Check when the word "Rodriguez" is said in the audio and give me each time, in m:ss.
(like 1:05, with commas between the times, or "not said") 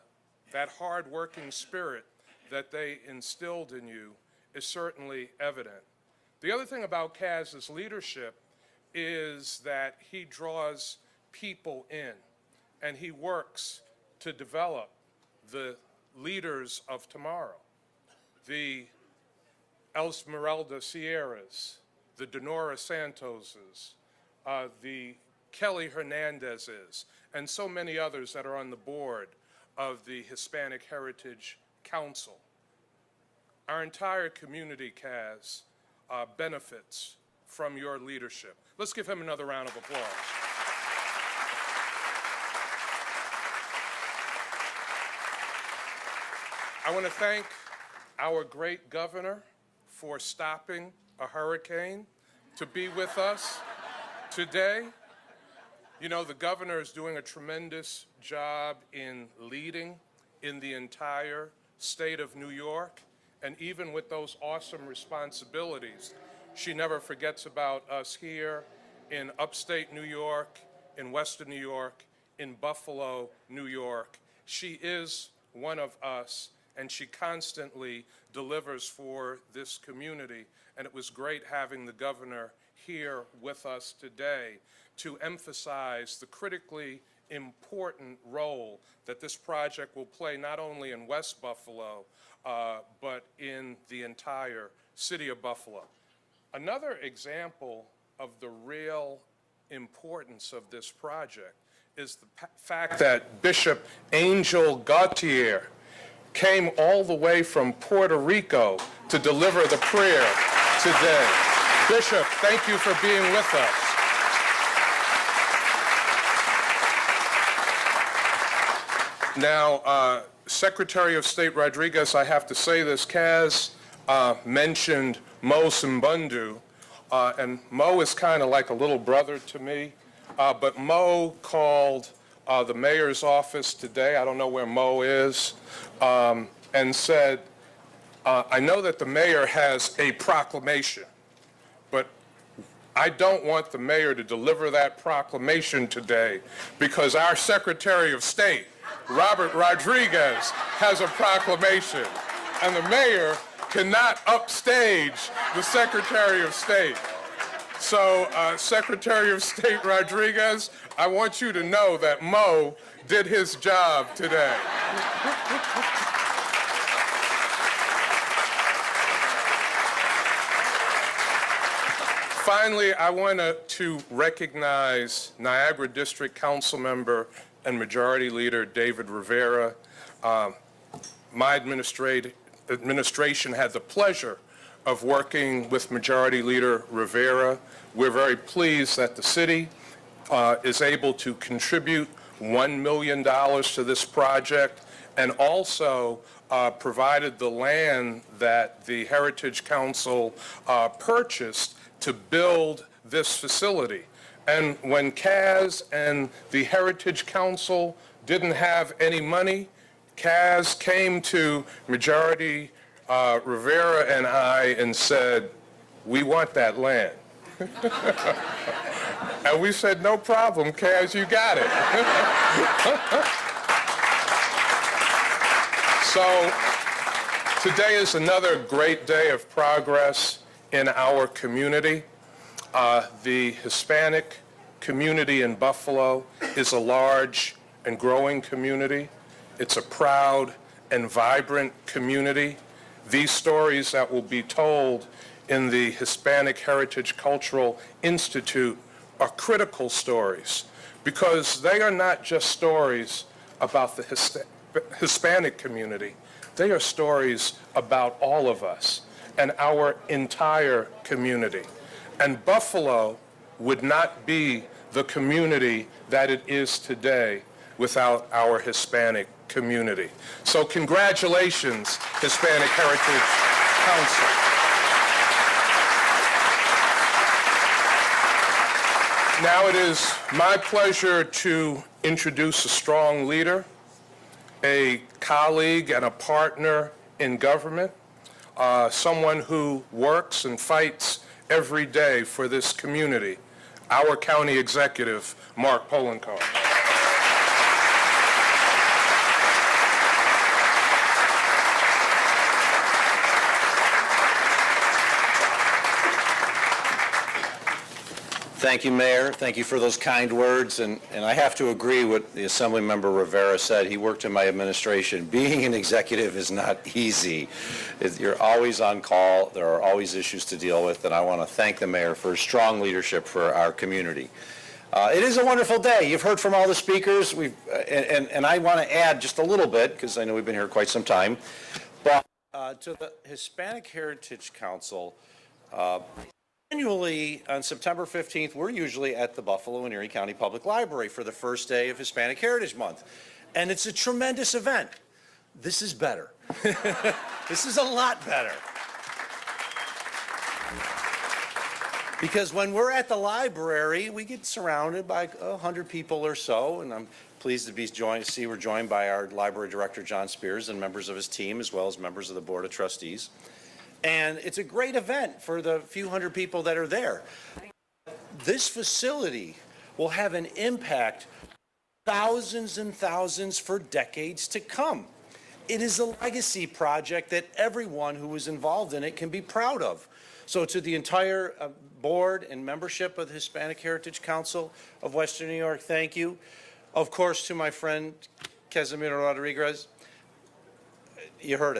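2:01, 2:29, 2:39, 6:29.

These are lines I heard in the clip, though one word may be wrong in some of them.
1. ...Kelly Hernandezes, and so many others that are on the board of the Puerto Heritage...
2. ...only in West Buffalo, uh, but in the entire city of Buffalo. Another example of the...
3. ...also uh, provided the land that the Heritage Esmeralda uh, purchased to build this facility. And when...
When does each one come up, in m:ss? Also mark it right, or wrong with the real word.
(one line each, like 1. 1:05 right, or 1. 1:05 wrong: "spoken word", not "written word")
1. 0:25 wrong: "Hispanic", not "Puerto"
2. 1:30 right
3. 3:15 wrong: "Council", not "Esmeralda".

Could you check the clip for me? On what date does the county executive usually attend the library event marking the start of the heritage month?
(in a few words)
September 15th.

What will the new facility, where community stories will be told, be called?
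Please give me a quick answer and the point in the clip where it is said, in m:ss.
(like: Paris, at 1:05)
Hispanic Heritage Cultural Institute, at 4:05.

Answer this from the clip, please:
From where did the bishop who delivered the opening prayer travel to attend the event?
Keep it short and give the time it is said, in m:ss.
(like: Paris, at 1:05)
Puerto Rico, at 1:47.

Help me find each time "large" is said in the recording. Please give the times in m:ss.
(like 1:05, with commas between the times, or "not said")
3:56.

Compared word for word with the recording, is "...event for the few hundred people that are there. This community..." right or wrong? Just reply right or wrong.
wrong.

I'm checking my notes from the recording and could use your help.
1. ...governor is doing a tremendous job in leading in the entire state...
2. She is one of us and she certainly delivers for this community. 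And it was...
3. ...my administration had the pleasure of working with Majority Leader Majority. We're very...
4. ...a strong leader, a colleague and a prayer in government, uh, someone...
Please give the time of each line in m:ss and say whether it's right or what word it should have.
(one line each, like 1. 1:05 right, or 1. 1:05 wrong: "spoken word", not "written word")
1. 0:56 right
2. 1:14 wrong: "constantly", not "certainly"
3. 3:01 wrong: "Rivera", not "Majority"
4. 4:42 wrong: "partner", not "prayer".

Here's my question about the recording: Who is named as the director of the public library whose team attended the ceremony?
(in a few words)
John Spears.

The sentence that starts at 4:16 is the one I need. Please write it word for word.
They are stories about all of us and our entire community.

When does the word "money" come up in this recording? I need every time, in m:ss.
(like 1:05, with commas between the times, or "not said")
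3:29.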